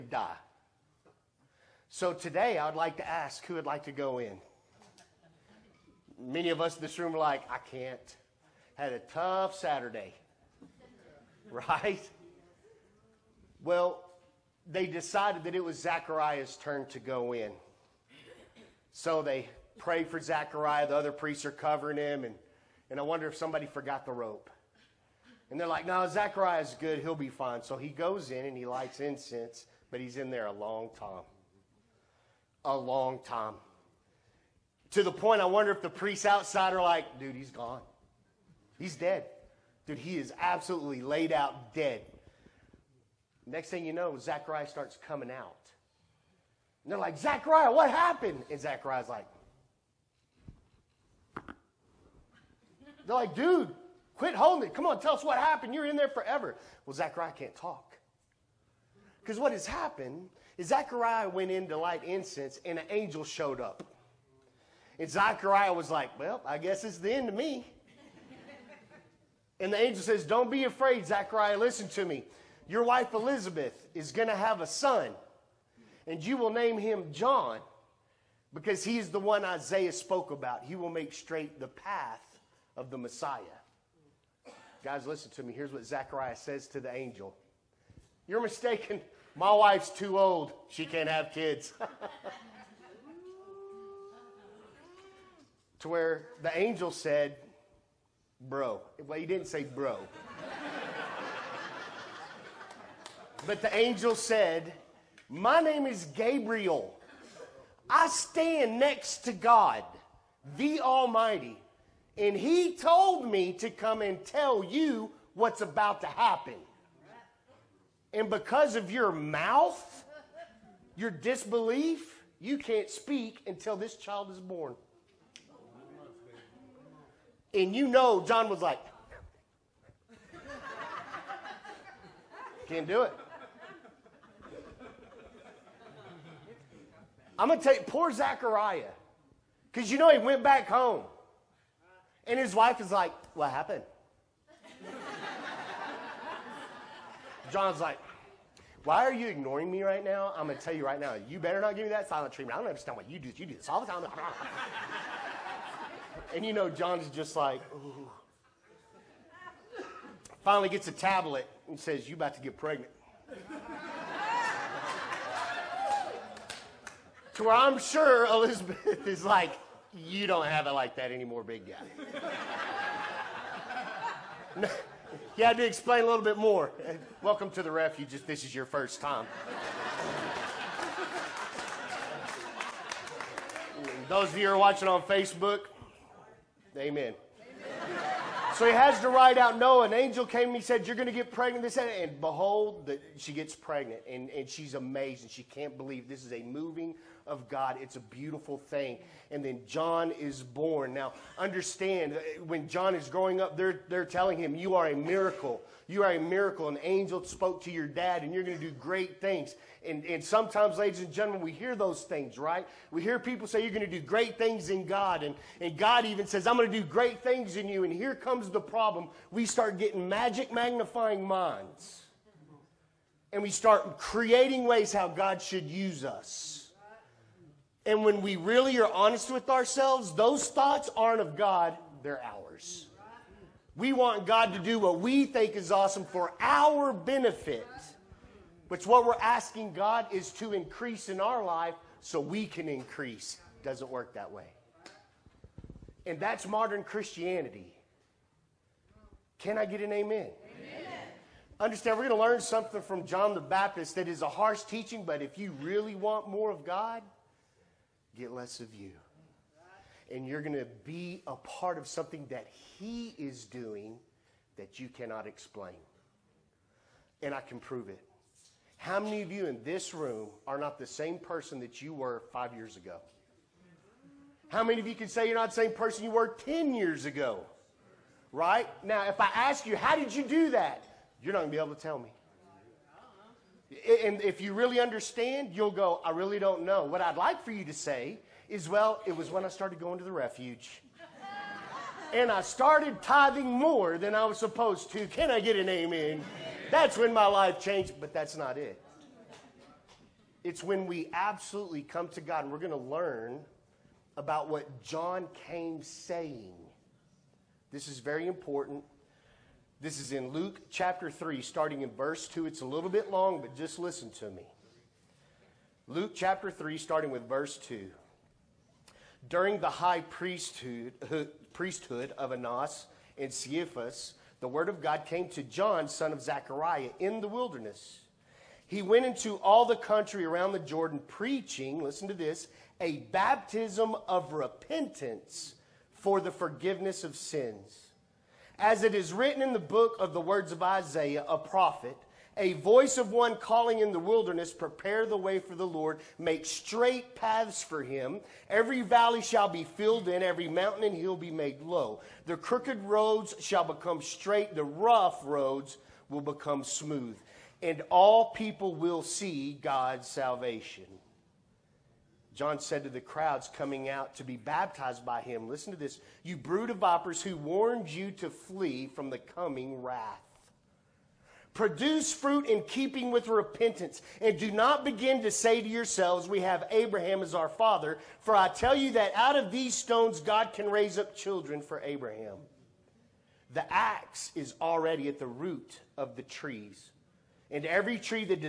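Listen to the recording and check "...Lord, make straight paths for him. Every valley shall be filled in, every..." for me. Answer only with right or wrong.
right.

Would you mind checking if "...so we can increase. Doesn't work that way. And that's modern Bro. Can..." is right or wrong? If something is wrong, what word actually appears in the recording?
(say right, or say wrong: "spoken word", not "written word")
wrong: "Christianity", not "Bro".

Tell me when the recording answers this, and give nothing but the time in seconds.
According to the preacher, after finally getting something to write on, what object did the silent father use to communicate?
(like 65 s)
160 s.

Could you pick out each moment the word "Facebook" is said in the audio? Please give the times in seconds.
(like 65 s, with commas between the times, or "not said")
185 s.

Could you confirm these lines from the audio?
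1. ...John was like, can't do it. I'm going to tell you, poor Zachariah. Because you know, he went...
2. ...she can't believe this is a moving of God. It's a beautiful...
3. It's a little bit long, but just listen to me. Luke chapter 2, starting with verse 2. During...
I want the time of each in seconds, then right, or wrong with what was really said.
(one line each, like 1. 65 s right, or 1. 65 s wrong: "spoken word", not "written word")
1. 128 s right
2. 195 s right
3. 312 s wrong: "3", not "2".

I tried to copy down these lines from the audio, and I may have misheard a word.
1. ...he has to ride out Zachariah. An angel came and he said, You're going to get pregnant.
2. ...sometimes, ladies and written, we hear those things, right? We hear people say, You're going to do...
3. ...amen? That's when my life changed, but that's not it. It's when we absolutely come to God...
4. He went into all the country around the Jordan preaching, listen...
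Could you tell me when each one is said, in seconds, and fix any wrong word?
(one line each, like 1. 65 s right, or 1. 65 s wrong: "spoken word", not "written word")
1. 188 s wrong: "Noah", not "Zachariah"
2. 210 s wrong: "gentlemen", not "written"
3. 295 s right
4. 328 s right.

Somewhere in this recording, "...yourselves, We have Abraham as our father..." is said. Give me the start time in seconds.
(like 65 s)
375 s.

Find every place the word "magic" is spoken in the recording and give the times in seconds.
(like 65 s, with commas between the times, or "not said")
220 s.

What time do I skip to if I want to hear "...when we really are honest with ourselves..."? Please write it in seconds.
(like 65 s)
228 s.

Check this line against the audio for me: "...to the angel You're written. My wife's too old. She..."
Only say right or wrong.
wrong.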